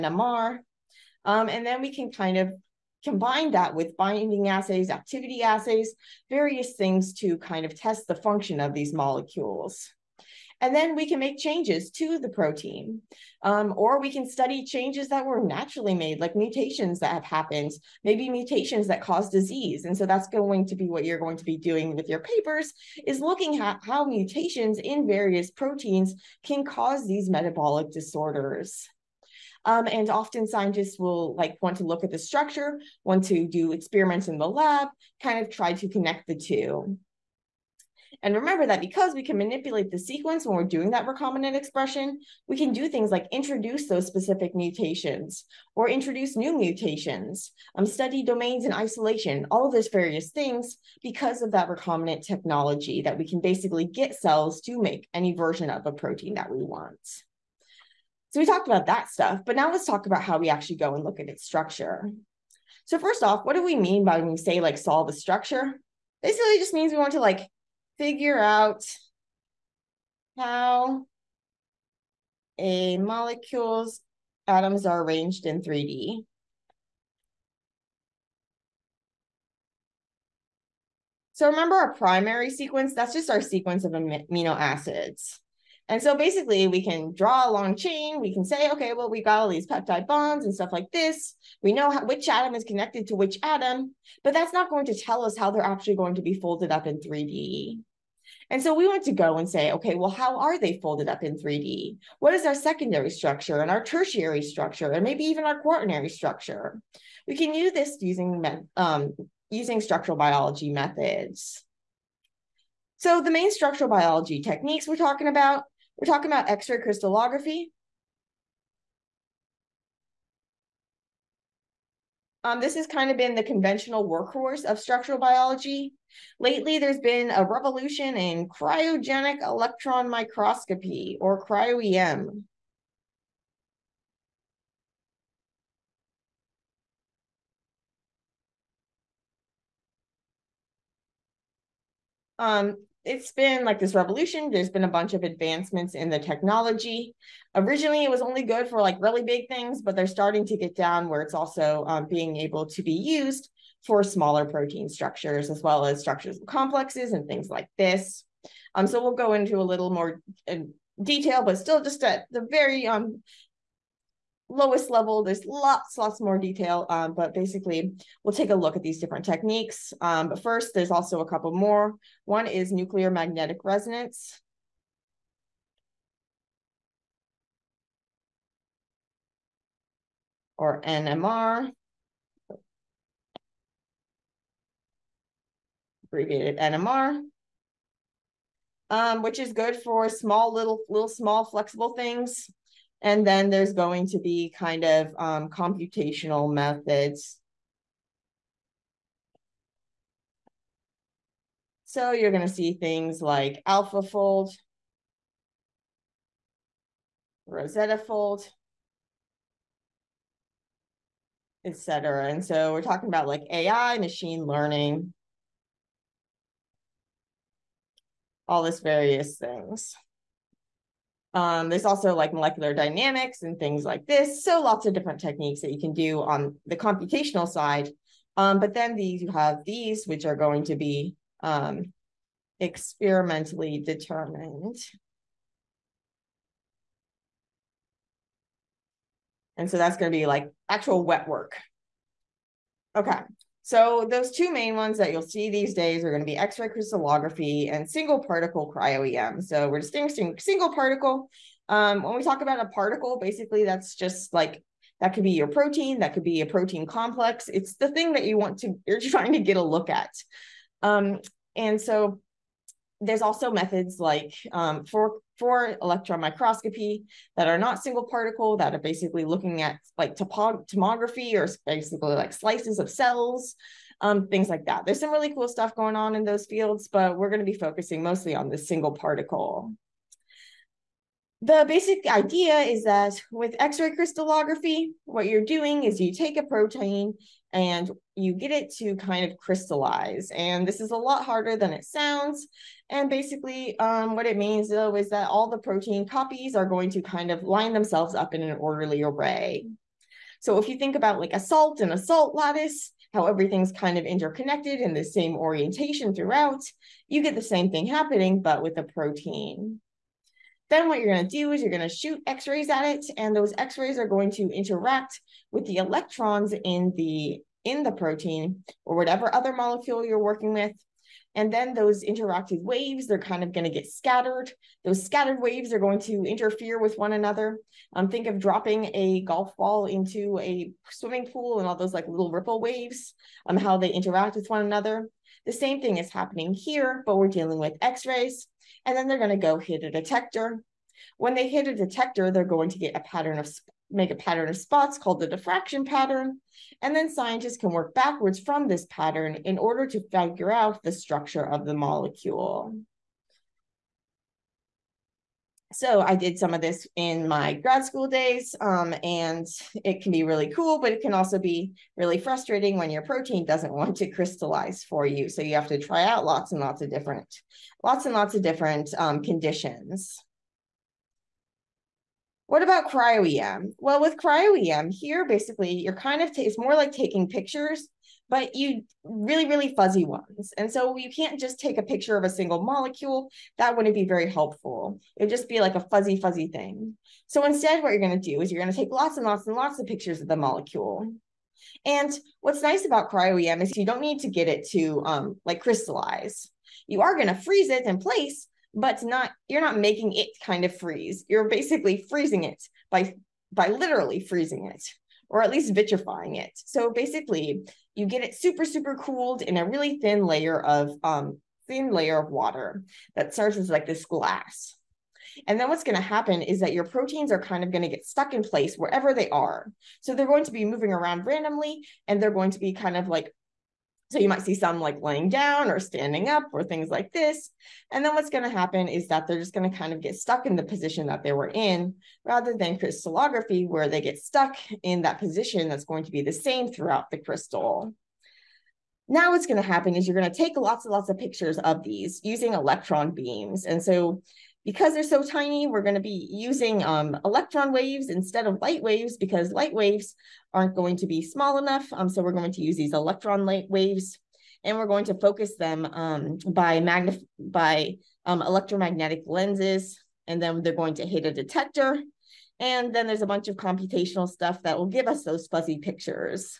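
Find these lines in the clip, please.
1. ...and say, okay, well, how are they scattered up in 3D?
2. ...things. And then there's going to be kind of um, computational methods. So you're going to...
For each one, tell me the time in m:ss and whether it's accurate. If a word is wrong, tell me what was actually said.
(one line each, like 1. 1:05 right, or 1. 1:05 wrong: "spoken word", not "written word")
1. 1:39 wrong: "folded", not "scattered"
2. 3:11 right.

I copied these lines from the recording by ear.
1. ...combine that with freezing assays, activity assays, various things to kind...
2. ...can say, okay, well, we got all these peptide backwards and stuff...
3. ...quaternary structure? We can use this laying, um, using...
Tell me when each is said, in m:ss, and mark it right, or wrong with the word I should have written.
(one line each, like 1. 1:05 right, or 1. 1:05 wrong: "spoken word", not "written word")
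1. 0:03 wrong: "binding", not "freezing"
2. 1:28 wrong: "bonds", not "backwards"
3. 1:45 wrong: "using", not "laying".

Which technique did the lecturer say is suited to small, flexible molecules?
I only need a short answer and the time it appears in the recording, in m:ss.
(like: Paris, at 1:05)
nuclear magnetic resonance, at 2:52.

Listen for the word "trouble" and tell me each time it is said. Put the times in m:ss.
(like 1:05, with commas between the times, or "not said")
not said.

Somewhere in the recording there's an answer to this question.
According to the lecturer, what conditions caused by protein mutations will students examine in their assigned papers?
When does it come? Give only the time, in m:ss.
0:27.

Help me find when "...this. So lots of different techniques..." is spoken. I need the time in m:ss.
3:44.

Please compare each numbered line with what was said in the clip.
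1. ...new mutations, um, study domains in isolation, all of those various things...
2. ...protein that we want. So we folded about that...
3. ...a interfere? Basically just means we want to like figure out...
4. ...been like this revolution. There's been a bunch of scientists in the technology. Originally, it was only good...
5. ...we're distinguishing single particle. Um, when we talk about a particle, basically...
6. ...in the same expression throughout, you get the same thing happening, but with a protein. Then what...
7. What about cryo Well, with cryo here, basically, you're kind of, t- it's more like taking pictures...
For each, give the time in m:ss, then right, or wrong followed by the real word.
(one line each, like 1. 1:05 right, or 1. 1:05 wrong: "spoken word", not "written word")
1. 0:46 right
2. 0:55 wrong: "talked", not "folded"
3. 1:05 wrong: "structure", not "interfere"
4. 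2:23 wrong: "advancements", not "scientists"
5. 4:09 right
6. 5:04 wrong: "orientation", not "expression"
7. 6:12 right.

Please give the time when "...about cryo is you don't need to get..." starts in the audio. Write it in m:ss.
6:32.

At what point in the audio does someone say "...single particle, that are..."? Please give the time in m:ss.
4:27.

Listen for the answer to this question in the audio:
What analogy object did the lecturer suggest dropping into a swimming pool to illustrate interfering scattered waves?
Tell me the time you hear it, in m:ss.
5:29.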